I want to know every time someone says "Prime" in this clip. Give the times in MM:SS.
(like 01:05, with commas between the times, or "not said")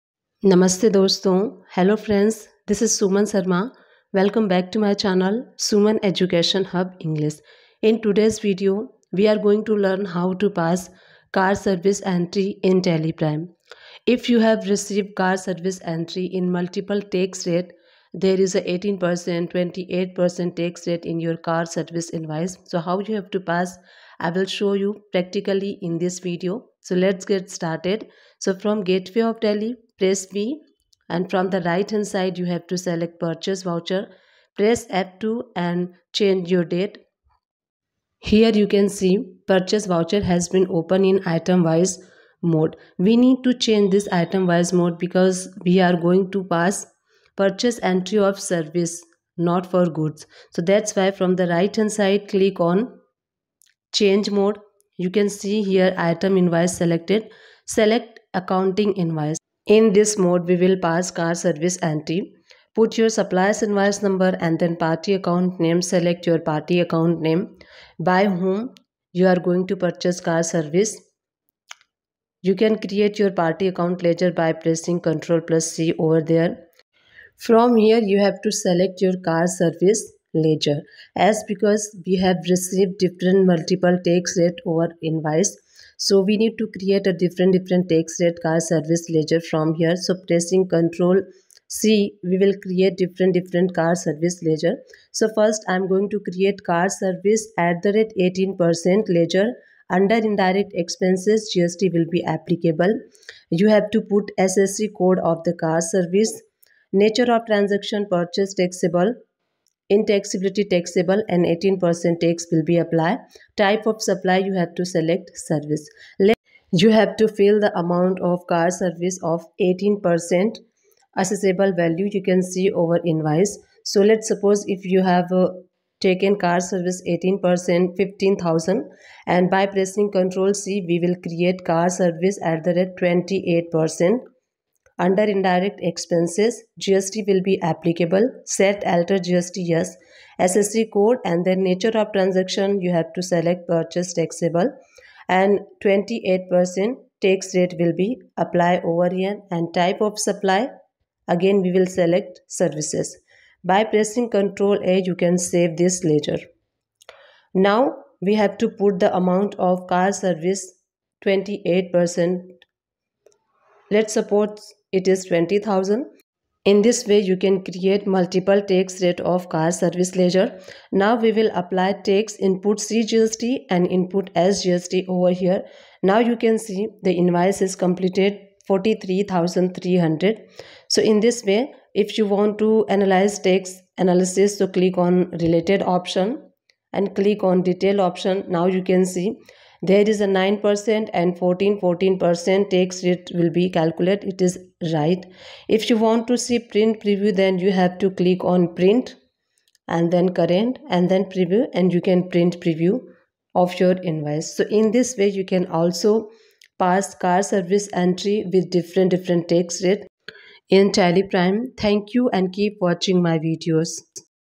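00:13, 03:31.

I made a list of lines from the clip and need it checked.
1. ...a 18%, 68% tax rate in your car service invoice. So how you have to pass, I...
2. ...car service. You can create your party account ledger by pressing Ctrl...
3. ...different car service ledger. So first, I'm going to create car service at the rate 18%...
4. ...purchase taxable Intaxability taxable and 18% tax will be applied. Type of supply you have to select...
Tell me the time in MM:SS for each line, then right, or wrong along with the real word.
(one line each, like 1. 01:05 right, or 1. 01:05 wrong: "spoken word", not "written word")
1. 00:18 wrong: "28", not "68"
2. 01:10 right
3. 01:33 right
4. 01:48 right.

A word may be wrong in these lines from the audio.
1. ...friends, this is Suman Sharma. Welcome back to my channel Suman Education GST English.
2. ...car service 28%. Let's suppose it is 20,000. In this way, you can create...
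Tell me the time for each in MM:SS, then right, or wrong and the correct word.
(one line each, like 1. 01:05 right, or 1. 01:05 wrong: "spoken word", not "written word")
1. 00:02 wrong: "Hub", not "GST"
2. 02:39 right.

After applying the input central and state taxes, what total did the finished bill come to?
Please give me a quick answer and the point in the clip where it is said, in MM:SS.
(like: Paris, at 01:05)
43,300, at 02:58.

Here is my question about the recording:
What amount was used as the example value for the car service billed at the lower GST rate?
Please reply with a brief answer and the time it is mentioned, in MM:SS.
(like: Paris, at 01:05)
15000, at 02:07.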